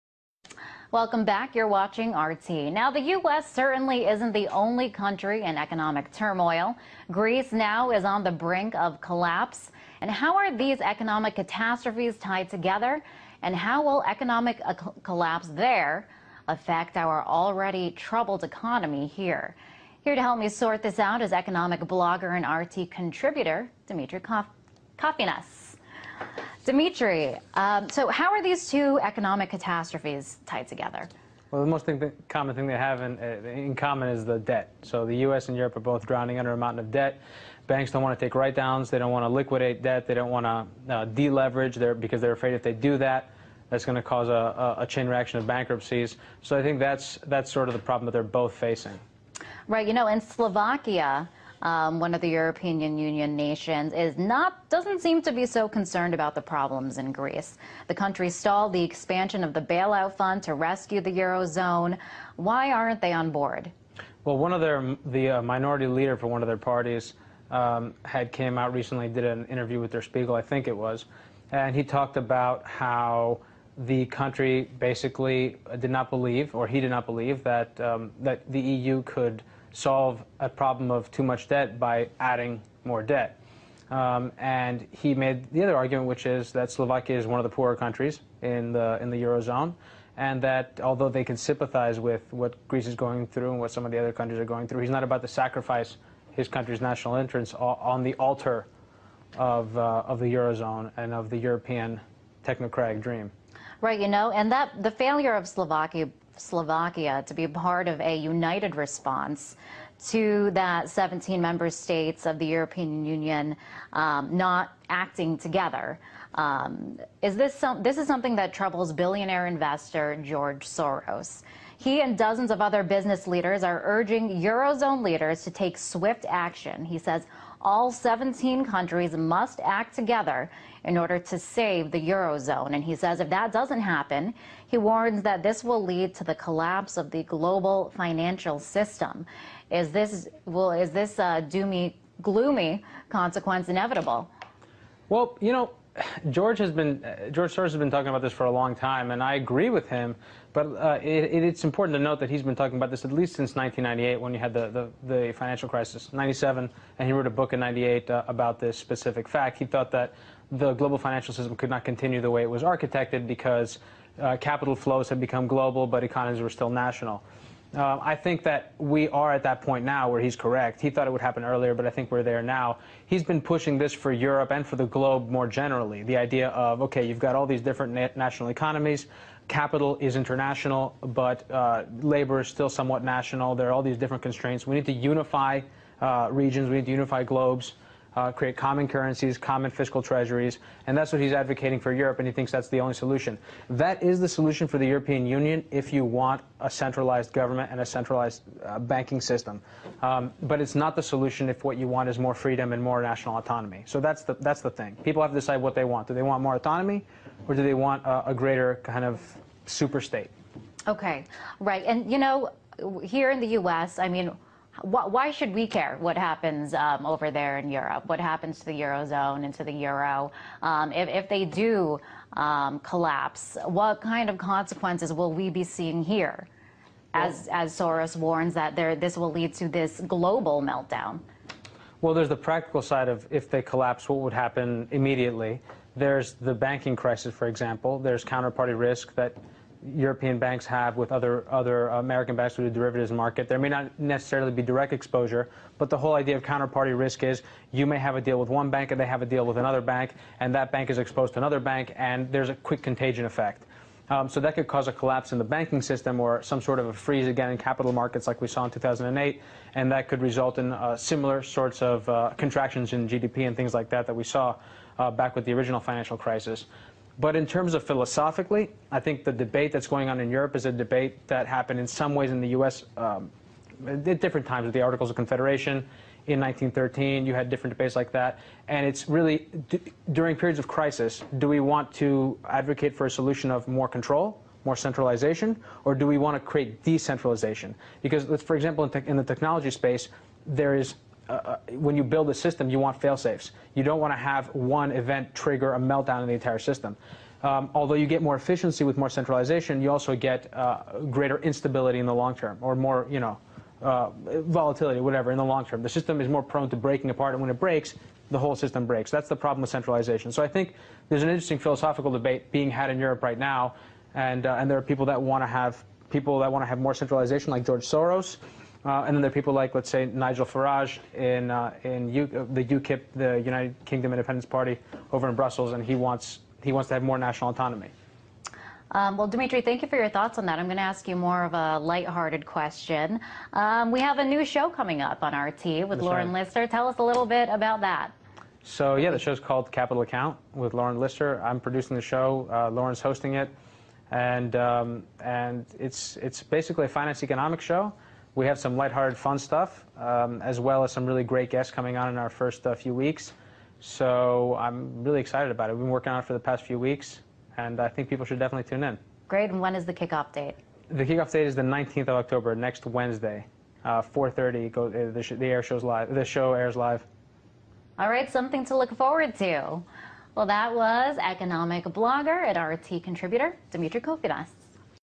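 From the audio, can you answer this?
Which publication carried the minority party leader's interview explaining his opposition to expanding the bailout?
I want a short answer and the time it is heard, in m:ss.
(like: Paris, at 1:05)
Der Spiegel, at 1:09.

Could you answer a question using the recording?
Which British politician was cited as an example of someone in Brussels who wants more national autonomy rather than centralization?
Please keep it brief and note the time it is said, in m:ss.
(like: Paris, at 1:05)
Nigel Farage, at 5:20.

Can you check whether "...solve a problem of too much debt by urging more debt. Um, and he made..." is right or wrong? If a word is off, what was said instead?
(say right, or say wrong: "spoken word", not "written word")
wrong: "adding", not "urging".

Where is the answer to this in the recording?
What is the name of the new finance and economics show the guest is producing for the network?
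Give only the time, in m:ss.
5:39.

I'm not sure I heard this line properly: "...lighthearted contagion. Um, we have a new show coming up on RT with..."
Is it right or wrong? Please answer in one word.
wrong.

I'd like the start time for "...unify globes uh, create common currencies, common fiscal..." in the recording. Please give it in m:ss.
3:06.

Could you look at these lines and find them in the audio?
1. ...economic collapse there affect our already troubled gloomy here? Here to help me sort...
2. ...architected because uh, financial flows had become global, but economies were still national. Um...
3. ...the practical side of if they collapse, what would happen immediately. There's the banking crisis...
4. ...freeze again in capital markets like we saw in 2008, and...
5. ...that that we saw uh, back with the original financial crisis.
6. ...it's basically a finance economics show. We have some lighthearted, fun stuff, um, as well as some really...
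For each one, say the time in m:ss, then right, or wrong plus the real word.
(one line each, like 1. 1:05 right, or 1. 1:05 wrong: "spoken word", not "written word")
1. 0:14 wrong: "economy", not "gloomy"
2. 2:42 wrong: "capital", not "financial"
3. 3:52 right
4. 4:16 right
5. 4:23 right
6. 5:46 right.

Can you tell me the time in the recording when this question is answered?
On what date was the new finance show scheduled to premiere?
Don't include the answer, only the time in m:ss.
6:01.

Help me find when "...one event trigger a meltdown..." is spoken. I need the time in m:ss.
4:54.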